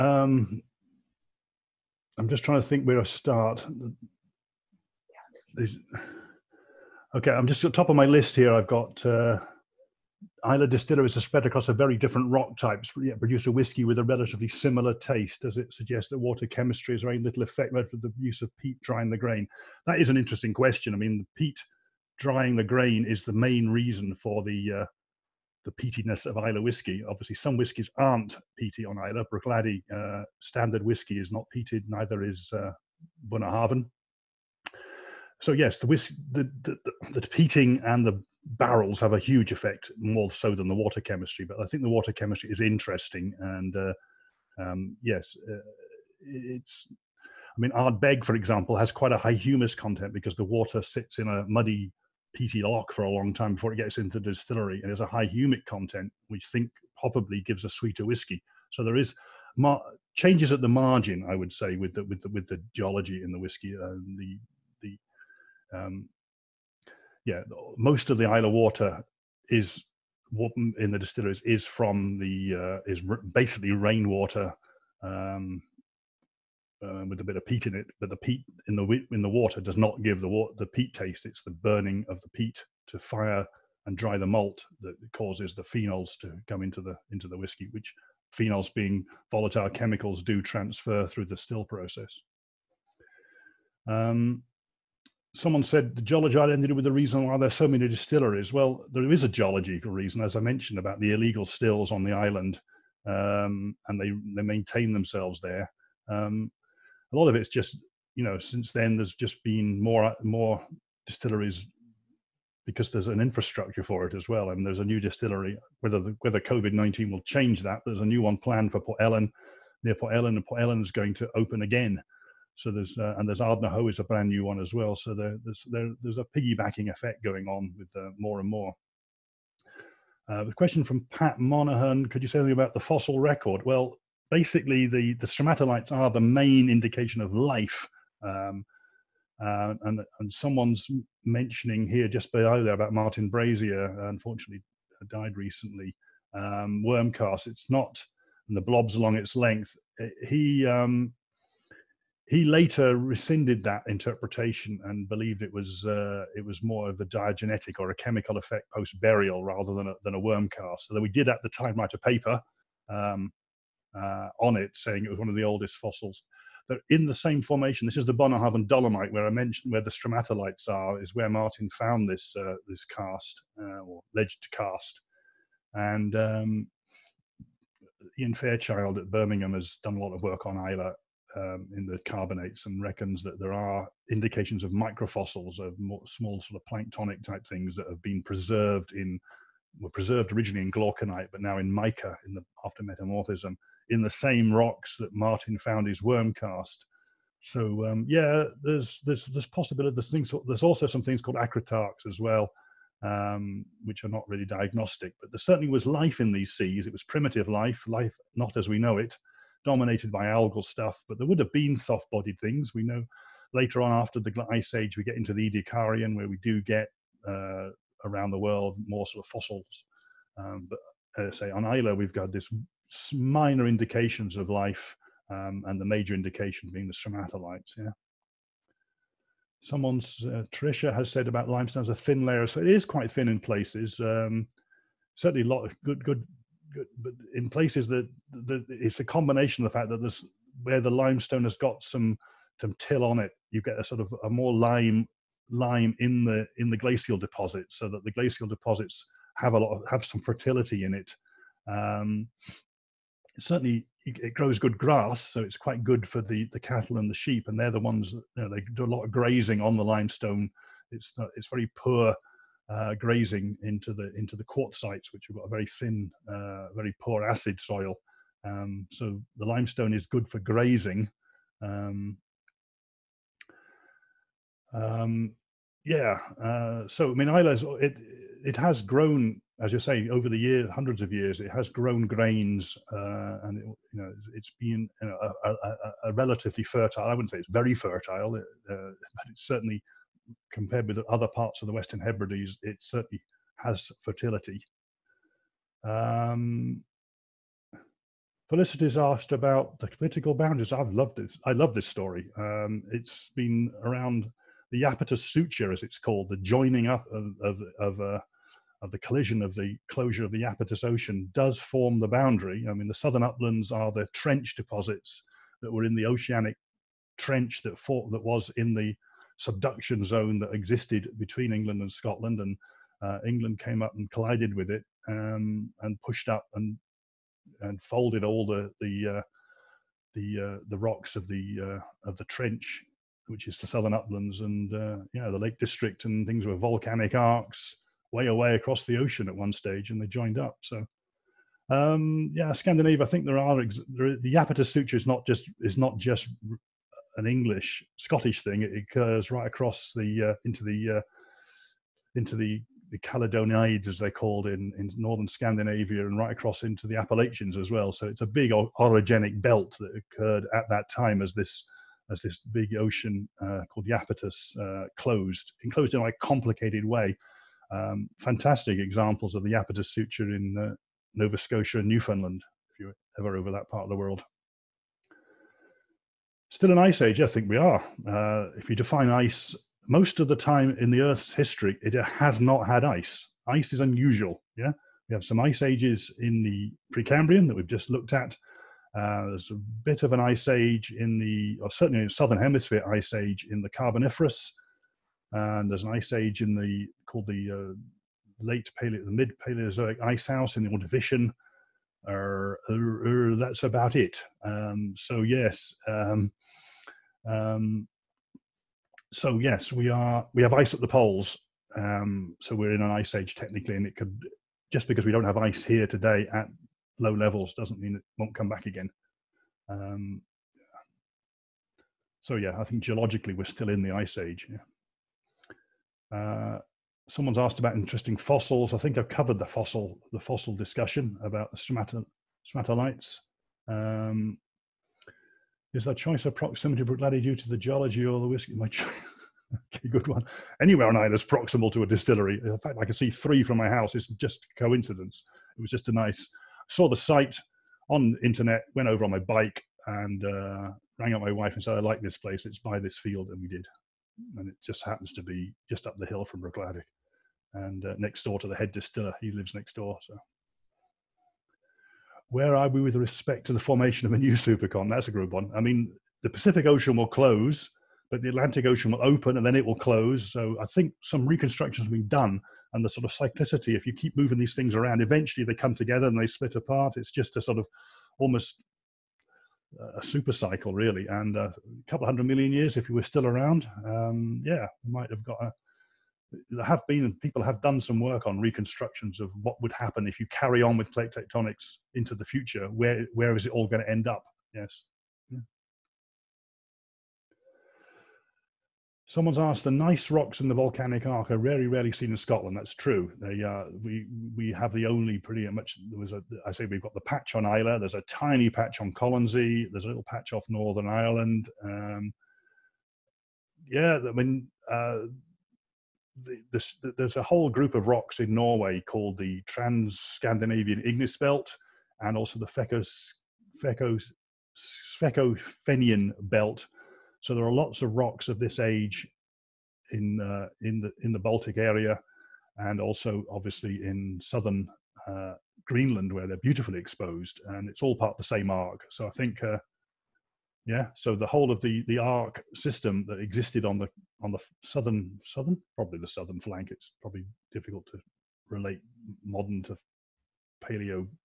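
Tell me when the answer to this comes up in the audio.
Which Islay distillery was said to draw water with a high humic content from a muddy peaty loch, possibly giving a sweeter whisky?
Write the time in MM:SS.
00:47.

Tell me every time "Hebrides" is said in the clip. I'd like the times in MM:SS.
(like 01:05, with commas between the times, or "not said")
04:52.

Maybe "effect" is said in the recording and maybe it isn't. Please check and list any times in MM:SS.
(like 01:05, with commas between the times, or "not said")
00:17, 00:39, 02:06, 02:38.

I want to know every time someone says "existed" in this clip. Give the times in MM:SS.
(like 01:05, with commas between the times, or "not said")
05:20, 09:03.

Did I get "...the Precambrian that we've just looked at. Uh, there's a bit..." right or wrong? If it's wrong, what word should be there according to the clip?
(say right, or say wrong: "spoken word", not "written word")
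right.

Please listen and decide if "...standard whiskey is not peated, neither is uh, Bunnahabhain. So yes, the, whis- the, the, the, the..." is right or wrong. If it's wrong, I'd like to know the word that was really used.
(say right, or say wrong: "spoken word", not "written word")
right.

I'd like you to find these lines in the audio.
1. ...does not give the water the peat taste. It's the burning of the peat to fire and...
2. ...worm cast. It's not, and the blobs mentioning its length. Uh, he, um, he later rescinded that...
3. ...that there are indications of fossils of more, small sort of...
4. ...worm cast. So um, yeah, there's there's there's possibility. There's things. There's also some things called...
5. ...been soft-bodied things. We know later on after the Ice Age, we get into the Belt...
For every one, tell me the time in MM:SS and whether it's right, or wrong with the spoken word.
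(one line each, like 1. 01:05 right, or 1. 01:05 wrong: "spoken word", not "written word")
1. 01:19 right
2. 02:26 wrong: "along", not "mentioning"
3. 03:03 wrong: "microfossils", not "fossils"
4. 03:16 right
5. 03:31 wrong: "Ediacarian", not "Belt".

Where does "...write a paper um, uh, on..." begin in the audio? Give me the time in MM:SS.
02:41.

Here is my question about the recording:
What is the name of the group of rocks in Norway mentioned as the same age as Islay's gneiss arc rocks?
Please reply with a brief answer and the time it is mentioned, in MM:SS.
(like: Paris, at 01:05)
Trans-Scandinavian Igneous Belt, at 08:39.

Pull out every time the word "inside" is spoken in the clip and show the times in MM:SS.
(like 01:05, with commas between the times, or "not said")
not said.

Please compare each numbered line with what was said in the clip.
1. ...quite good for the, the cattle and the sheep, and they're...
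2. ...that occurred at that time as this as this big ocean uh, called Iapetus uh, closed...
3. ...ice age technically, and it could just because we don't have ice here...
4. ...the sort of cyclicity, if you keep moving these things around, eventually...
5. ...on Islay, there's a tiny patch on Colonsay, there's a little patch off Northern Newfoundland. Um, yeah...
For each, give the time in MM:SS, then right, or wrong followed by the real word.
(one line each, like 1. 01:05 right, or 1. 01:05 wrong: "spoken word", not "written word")
1. 04:15 right
2. 05:59 right
3. 06:52 right
4. 07:52 right
5. 08:27 wrong: "Ireland", not "Newfoundland".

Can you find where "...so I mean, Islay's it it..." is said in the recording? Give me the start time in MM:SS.
04:36.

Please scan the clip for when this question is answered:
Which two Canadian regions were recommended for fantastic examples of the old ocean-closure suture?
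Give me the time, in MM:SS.
06:11.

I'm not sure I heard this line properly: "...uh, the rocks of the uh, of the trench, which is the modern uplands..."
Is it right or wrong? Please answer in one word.
wrong.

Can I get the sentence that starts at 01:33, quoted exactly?
Um, someone said the geology ended with the reason why there's so many distilleries.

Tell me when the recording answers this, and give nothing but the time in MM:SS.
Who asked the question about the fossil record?
02:11.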